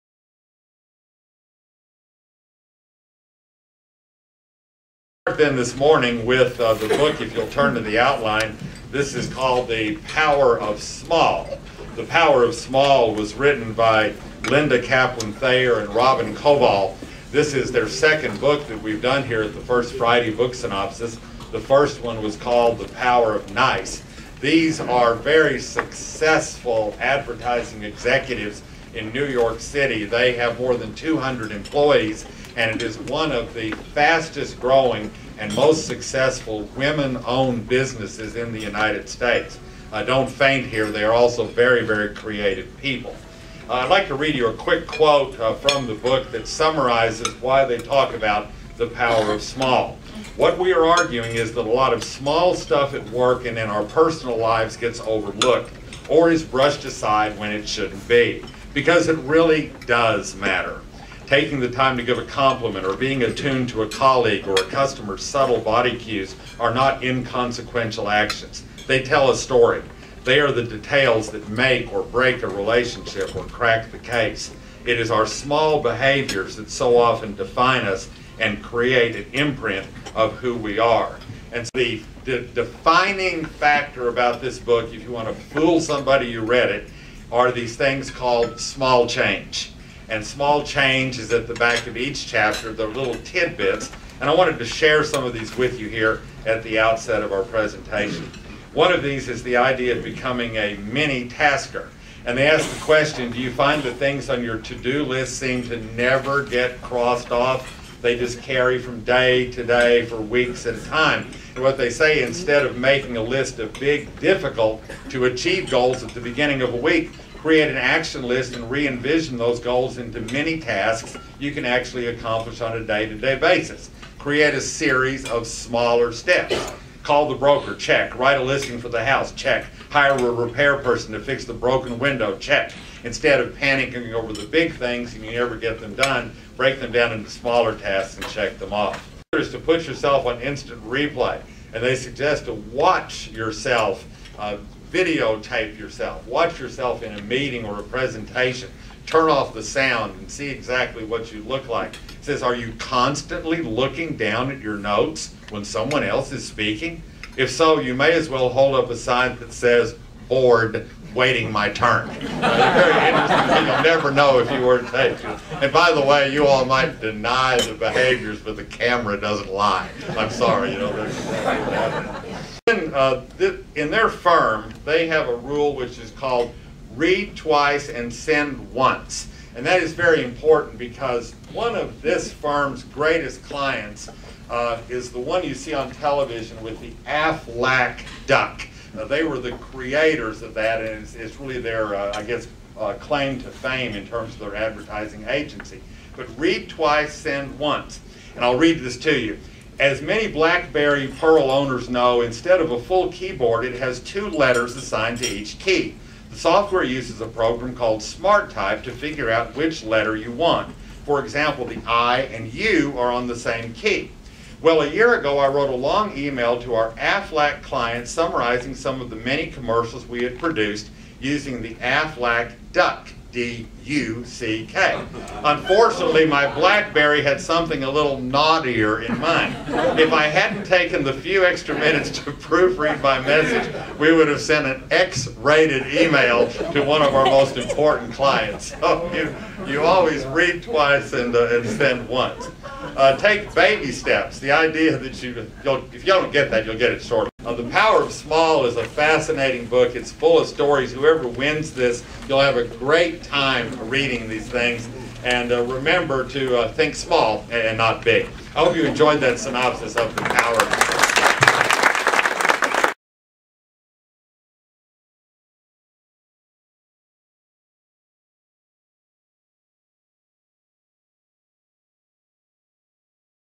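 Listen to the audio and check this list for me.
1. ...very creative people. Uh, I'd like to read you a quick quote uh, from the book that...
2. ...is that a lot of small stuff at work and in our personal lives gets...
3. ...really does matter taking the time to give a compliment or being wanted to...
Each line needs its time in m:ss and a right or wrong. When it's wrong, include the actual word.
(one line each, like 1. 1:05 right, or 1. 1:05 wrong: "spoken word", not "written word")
1. 0:41 right
2. 0:51 right
3. 0:59 wrong: "attuned", not "wanted".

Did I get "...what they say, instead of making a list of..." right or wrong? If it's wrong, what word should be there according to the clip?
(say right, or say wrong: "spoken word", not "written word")
right.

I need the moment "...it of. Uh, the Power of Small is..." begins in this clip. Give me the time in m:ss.
4:06.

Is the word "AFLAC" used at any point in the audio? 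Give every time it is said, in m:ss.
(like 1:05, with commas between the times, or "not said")
3:07, 3:36, 3:41.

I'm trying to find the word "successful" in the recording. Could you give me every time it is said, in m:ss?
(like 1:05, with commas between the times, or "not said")
0:25, 0:35.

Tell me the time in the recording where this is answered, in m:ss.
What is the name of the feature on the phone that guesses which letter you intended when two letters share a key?
3:28.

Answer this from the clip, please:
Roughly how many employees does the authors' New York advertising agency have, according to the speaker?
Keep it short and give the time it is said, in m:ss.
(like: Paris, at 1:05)
200, at 0:30.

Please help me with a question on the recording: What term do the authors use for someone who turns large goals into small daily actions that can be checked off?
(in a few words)
mini tasker.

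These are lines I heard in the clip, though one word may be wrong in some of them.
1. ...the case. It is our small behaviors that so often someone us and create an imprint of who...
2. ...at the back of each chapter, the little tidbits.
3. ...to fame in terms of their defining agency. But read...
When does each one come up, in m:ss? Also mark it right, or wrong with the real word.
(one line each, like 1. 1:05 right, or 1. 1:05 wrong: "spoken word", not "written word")
1. 1:13 wrong: "define", not "someone"
2. 1:31 right
3. 3:13 wrong: "advertising", not "defining".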